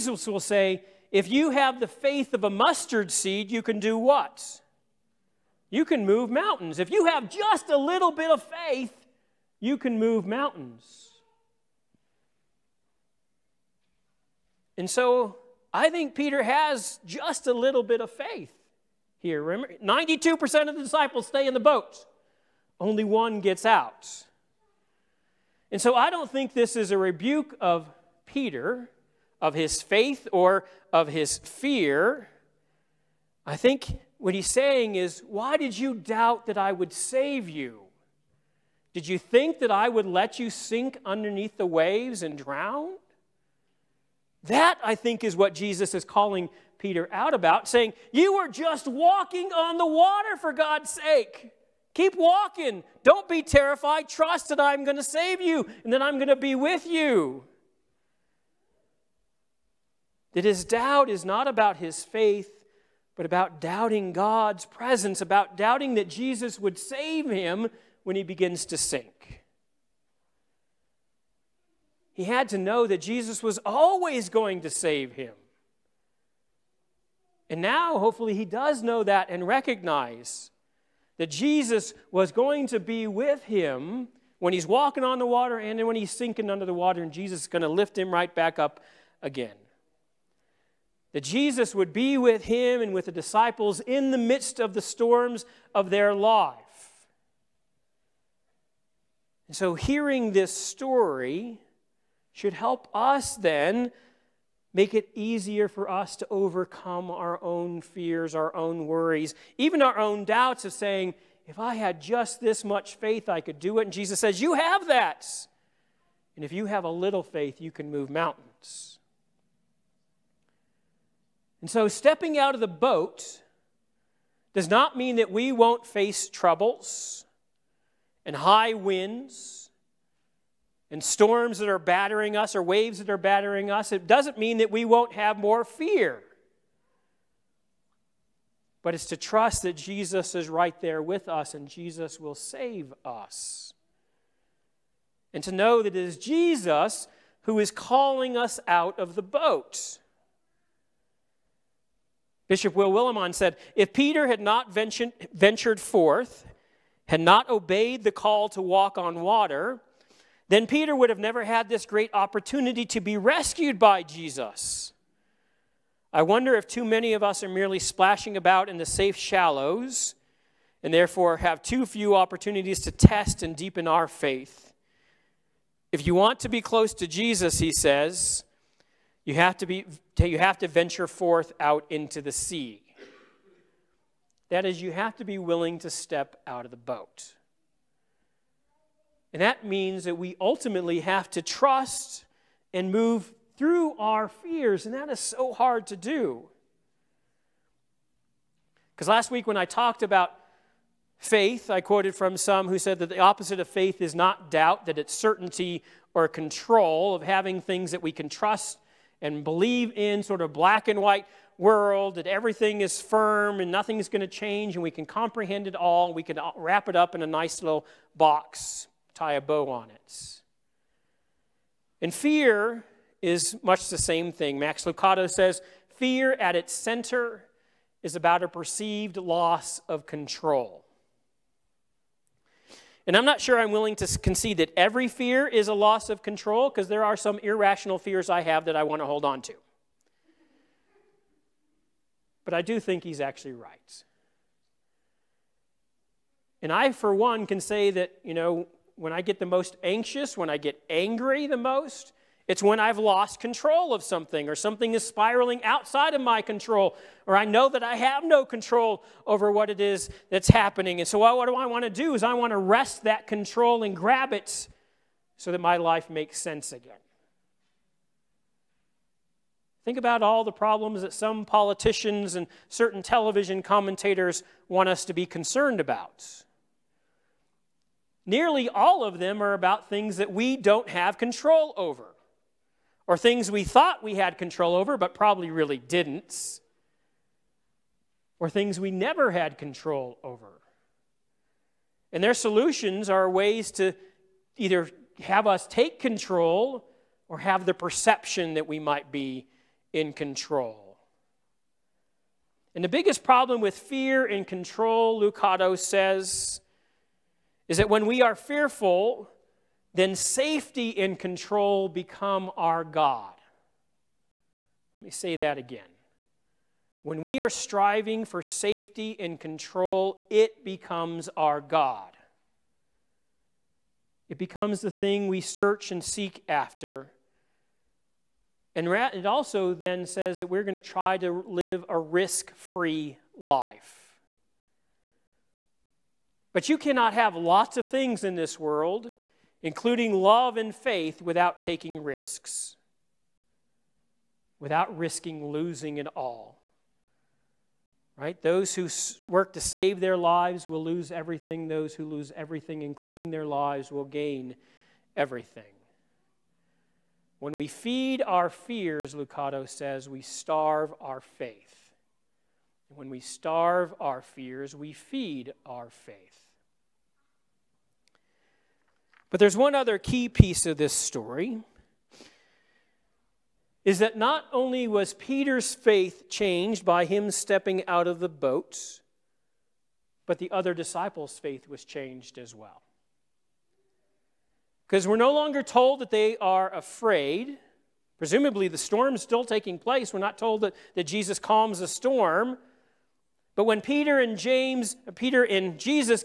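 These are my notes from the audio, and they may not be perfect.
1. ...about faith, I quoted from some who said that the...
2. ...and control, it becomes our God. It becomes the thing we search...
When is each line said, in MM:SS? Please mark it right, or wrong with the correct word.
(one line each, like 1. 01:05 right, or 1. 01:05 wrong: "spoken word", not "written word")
1. 03:20 right
2. 05:19 right.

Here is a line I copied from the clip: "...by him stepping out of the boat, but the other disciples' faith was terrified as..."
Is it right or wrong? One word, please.
wrong.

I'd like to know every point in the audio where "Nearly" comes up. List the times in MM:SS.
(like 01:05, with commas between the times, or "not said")
04:38.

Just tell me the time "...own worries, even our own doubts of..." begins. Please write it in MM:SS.
01:48.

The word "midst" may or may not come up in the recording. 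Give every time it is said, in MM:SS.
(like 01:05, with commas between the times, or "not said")
01:34.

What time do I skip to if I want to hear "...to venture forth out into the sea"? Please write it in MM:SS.
03:00.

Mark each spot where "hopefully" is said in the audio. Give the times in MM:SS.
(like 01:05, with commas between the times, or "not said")
01:17.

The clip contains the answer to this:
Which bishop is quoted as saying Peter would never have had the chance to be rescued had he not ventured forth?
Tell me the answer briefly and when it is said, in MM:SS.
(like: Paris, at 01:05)
Will Willimon, at 02:32.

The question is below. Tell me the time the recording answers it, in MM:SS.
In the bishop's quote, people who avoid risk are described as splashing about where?
02:48.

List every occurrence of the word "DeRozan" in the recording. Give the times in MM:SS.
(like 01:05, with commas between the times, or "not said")
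not said.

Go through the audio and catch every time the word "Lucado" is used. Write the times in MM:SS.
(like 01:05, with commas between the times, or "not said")
03:44, 05:05, 05:59.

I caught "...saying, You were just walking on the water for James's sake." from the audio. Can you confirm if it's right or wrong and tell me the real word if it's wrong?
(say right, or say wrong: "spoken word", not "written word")
wrong: "God", not "James".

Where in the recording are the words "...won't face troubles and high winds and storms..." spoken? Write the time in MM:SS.
02:05.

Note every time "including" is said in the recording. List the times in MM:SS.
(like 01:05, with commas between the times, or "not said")
05:39, 05:52.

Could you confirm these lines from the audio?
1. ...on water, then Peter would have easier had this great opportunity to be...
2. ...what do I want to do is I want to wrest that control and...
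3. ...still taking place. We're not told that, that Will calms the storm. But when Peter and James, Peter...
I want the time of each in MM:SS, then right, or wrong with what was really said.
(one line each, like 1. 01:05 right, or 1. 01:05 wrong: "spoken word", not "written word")
1. 02:38 wrong: "never", not "easier"
2. 04:21 right
3. 06:29 wrong: "Jesus", not "Will".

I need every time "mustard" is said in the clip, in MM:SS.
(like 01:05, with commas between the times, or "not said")
00:02.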